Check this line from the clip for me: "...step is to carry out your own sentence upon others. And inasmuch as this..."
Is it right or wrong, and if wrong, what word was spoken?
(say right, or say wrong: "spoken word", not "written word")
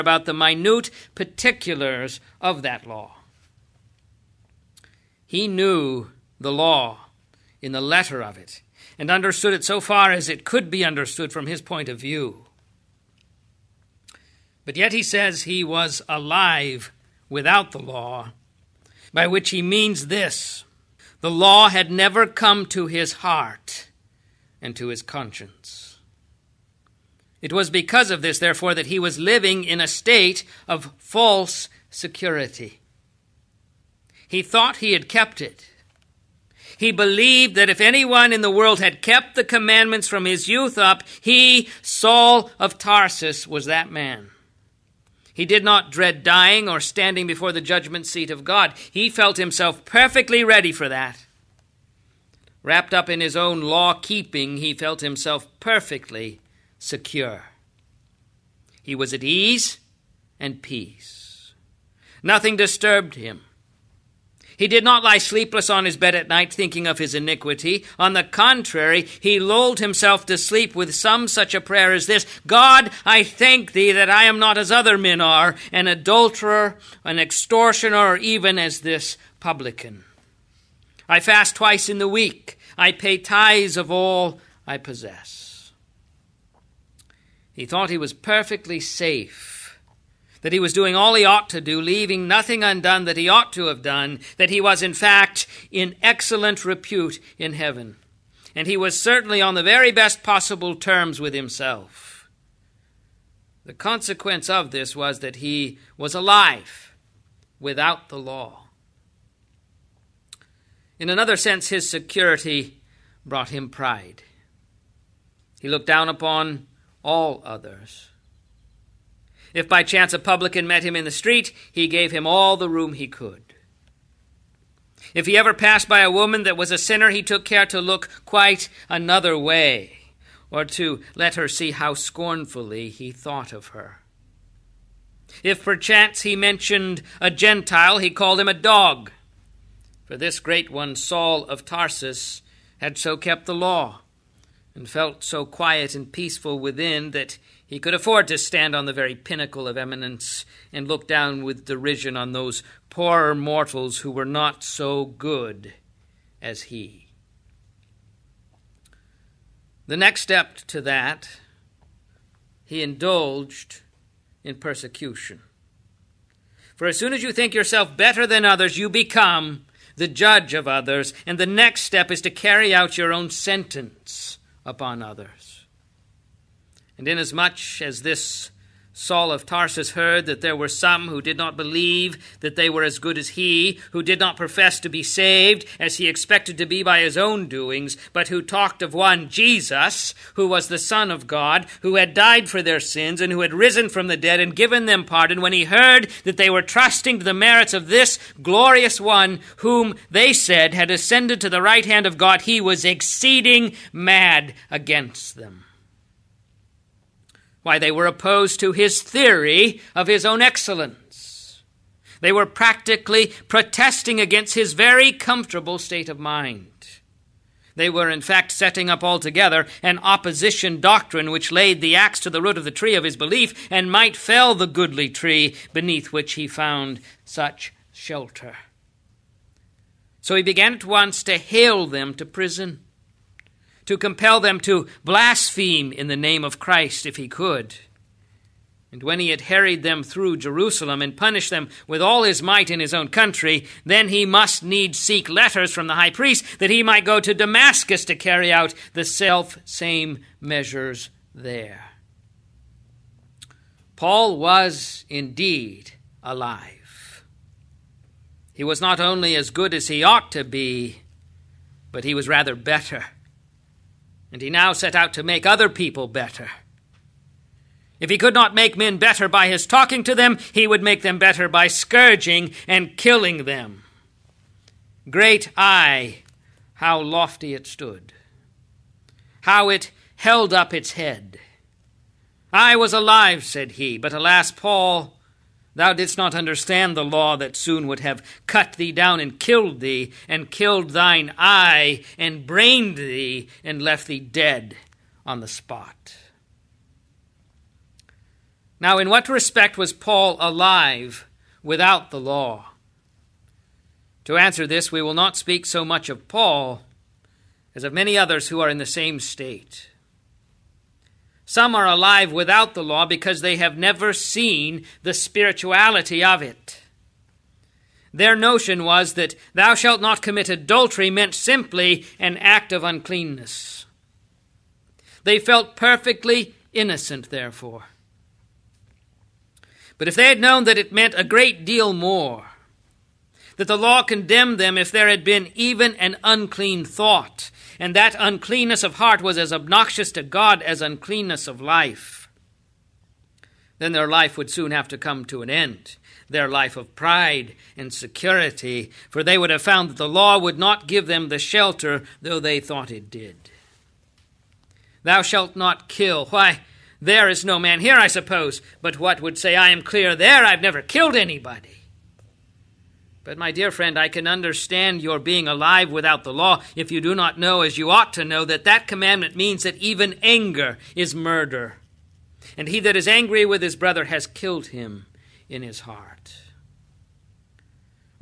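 right.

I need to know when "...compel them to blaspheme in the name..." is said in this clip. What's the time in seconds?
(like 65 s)
233 s.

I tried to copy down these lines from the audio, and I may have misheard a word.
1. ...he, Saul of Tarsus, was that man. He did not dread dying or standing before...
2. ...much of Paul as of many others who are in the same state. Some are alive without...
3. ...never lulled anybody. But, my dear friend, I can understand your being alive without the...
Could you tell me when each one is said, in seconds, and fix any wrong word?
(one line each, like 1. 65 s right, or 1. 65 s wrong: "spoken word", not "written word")
1. 41 s right
2. 305 s right
3. 360 s wrong: "killed", not "lulled".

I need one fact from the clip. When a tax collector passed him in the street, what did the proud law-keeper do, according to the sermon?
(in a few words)
gave him all the room he could.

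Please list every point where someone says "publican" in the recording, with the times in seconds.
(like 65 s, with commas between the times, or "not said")
79 s, 120 s.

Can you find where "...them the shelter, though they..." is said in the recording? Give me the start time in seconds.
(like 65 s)
351 s.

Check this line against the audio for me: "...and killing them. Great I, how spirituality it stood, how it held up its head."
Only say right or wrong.
wrong.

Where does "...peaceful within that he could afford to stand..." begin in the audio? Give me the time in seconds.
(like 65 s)
146 s.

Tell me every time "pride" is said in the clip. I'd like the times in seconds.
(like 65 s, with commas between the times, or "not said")
113 s, 346 s.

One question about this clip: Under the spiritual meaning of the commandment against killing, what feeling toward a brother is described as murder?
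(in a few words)
anger.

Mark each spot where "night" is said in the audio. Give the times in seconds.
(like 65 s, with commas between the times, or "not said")
66 s.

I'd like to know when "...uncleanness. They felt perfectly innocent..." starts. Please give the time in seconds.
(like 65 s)
322 s.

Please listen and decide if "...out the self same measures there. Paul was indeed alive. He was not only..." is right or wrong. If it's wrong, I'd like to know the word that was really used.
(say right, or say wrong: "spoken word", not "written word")
right.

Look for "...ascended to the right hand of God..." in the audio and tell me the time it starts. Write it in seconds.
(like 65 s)
200 s.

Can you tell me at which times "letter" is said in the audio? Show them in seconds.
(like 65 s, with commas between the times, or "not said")
7 s, 245 s.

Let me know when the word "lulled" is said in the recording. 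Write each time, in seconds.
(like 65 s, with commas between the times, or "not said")
69 s.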